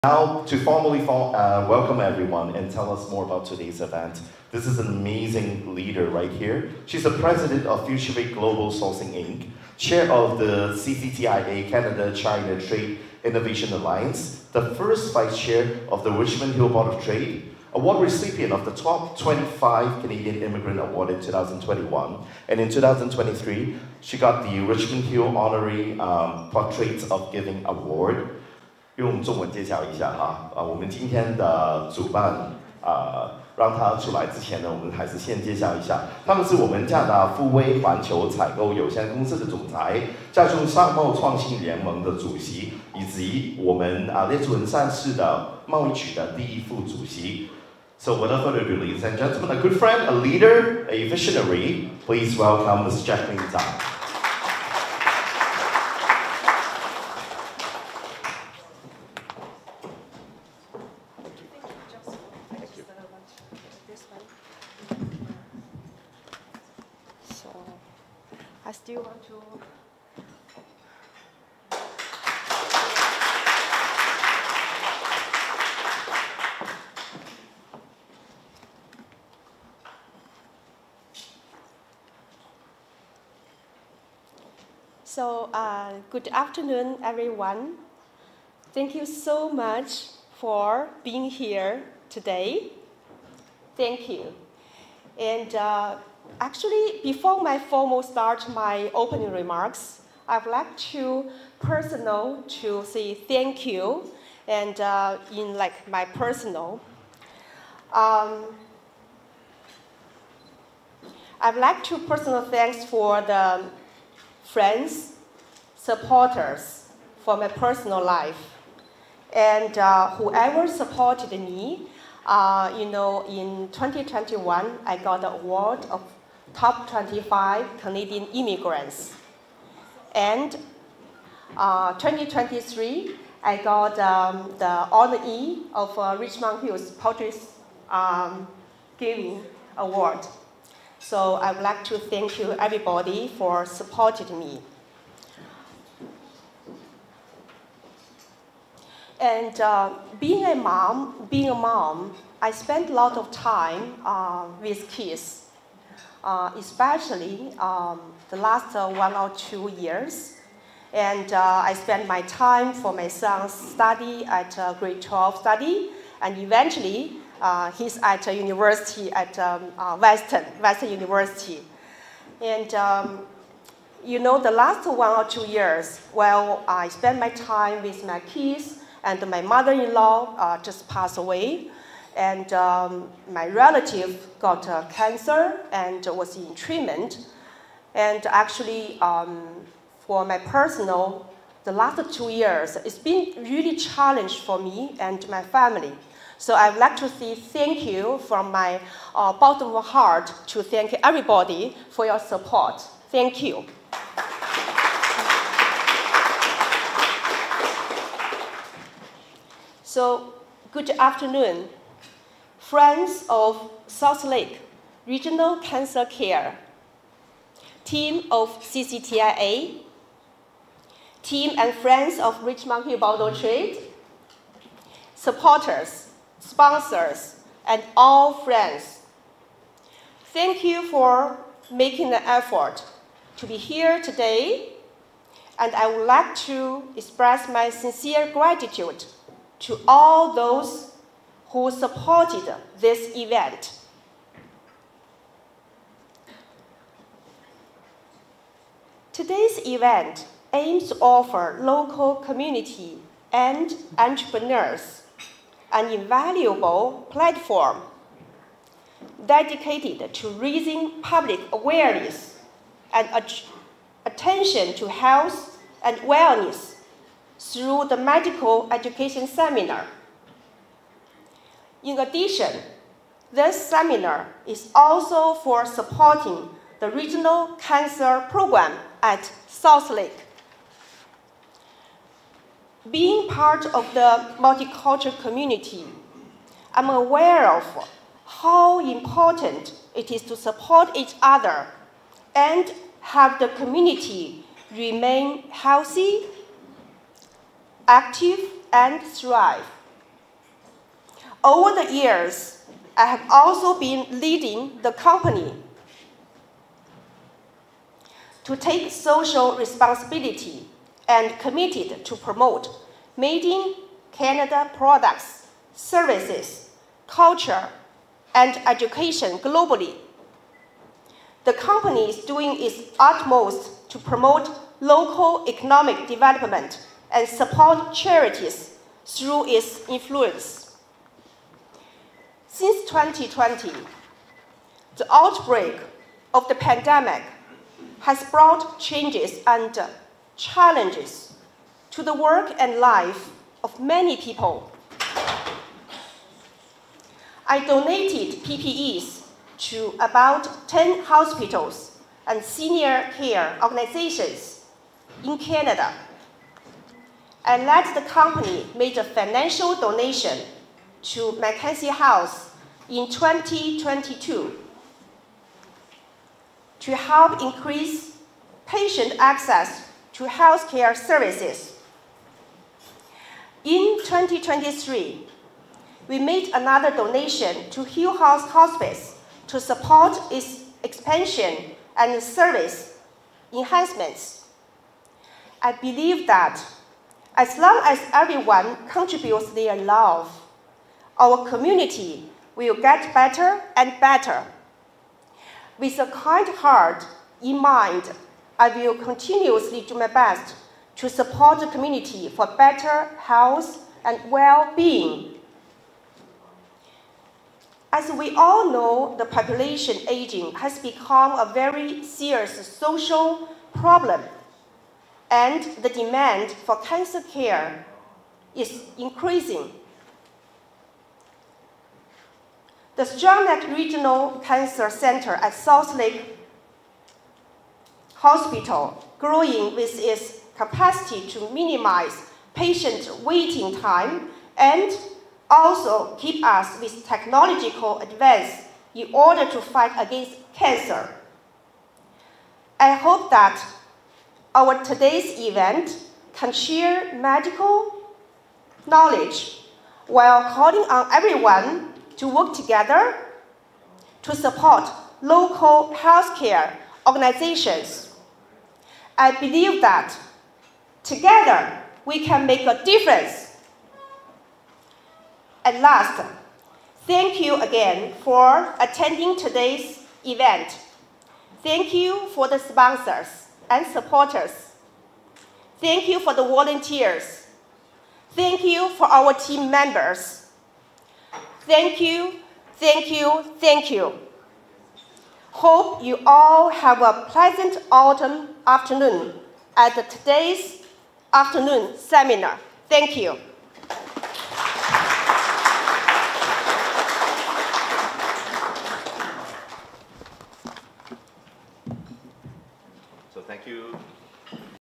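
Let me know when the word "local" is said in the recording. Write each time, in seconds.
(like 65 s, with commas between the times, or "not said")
251 s, 324 s, 455 s.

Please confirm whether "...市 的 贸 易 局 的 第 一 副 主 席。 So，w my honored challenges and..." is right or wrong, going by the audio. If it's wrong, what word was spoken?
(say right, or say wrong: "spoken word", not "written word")
wrong: "ladies", not "challenges".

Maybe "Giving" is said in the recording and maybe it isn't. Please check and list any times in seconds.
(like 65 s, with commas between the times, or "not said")
27 s, 138 s.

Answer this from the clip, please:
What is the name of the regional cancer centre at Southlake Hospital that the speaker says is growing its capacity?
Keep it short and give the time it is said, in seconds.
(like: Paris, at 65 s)
Stronach Regional Cancer Center, at 423 s.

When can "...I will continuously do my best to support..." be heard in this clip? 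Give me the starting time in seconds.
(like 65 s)
398 s.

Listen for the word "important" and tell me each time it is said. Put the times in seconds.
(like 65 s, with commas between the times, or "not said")
288 s.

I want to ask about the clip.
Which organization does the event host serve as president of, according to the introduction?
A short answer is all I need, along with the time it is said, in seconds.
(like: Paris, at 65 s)
Futurevate Global Sourcing Inc., at 7 s.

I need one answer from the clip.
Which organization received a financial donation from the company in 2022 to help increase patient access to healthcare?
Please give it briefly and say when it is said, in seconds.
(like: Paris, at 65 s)
Mackenzie House, at 361 s.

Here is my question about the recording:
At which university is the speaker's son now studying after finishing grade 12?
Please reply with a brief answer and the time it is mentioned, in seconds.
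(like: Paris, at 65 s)
Western University, at 170 s.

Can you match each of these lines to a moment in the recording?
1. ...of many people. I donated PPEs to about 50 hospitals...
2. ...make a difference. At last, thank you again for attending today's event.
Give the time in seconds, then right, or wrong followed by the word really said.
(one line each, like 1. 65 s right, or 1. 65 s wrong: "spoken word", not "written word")
1. 343 s wrong: "10", not "50"
2. 462 s right.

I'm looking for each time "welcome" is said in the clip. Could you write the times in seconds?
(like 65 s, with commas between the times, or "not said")
1 s, 52 s.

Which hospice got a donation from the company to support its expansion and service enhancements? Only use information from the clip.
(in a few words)
Hill House Hospice.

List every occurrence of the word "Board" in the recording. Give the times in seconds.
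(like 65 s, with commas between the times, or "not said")
16 s, 222 s.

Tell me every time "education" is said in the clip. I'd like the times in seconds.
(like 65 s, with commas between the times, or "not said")
268 s, 318 s.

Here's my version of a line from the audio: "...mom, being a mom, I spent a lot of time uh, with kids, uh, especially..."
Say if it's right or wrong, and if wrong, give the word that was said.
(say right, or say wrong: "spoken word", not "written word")
right.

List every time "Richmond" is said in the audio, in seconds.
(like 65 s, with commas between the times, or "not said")
16 s, 24 s, 136 s, 222 s.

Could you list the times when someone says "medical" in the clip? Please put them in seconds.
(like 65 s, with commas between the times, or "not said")
267 s, 447 s.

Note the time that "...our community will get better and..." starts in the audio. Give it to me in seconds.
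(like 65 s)
391 s.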